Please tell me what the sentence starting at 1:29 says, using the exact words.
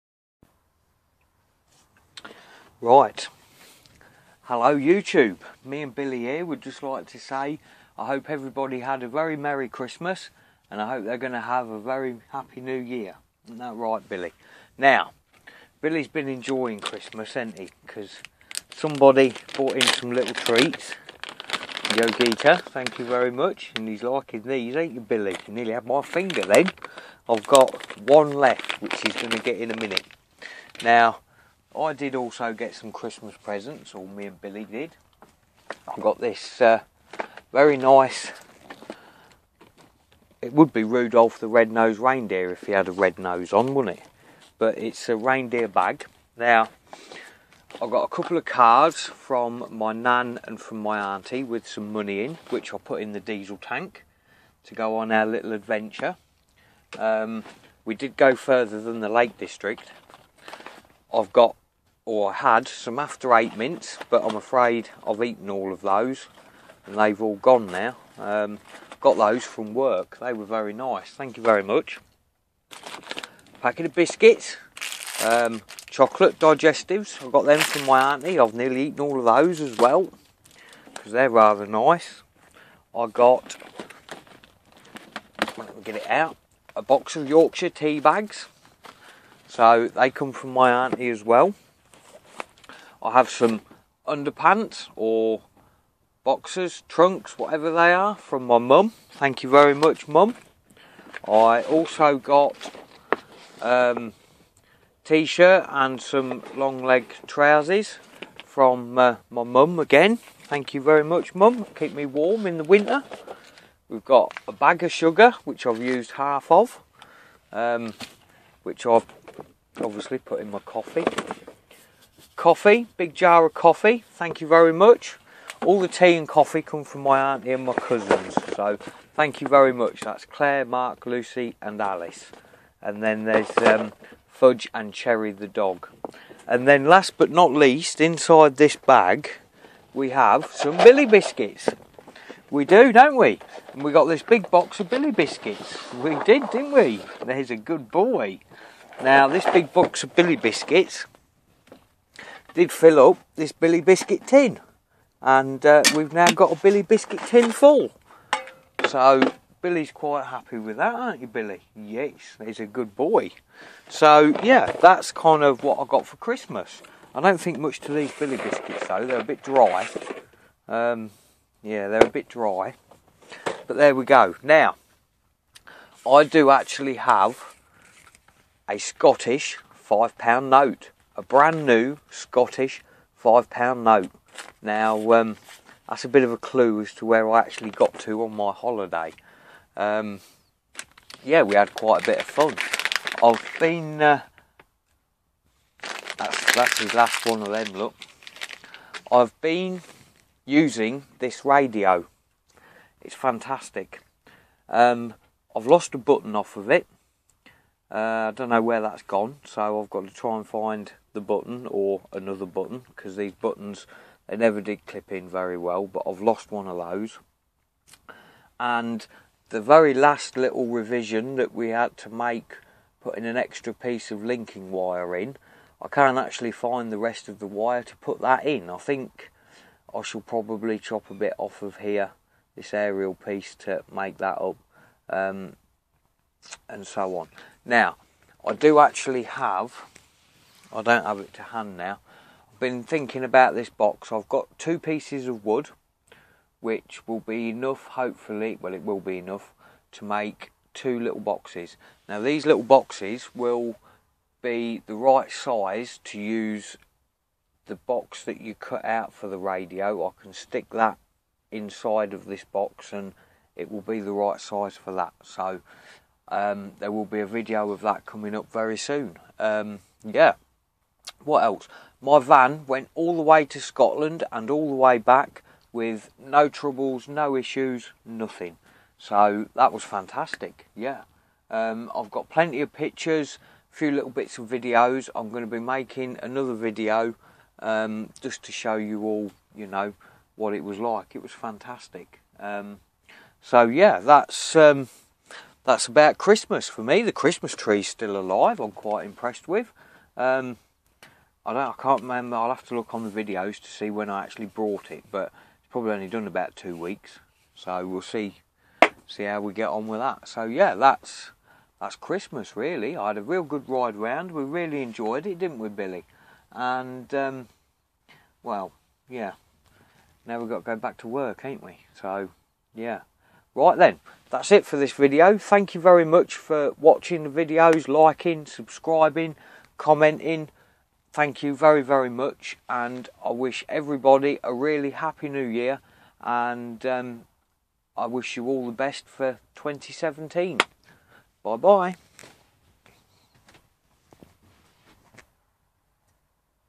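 So they come from my auntie as well.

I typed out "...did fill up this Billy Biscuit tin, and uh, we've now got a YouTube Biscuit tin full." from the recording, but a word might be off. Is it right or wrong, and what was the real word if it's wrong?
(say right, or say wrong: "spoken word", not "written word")
wrong: "Billy", not "YouTube".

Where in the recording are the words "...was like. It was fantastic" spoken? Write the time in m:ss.
4:50.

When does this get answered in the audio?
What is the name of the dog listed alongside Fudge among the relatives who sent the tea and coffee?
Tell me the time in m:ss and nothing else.
2:14.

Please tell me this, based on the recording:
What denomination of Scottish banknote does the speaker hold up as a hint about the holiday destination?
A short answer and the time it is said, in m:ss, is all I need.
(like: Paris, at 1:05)
£5, at 3:03.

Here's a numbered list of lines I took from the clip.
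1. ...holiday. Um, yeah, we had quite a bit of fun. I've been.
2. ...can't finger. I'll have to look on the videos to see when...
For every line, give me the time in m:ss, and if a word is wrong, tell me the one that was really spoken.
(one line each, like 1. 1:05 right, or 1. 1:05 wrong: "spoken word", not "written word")
1. 3:08 right
2. 5:01 wrong: "remember", not "finger".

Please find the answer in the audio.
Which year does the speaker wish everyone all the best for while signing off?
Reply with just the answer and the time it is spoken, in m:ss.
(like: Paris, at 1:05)
2017, at 5:39.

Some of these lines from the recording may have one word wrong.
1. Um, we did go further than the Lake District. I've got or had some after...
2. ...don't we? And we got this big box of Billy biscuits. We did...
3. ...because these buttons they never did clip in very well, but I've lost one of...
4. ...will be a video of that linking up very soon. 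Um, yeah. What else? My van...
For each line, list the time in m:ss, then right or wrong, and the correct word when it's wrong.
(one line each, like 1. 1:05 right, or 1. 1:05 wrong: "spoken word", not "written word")
1. 0:56 right
2. 2:22 right
3. 3:32 right
4. 4:26 wrong: "coming", not "linking".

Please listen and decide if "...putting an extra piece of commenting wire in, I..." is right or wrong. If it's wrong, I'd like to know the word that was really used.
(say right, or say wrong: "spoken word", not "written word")
wrong: "linking", not "commenting".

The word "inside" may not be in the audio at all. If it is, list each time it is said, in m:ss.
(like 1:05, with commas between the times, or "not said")
2:18, 4:21.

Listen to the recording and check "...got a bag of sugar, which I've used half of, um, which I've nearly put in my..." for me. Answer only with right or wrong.
wrong.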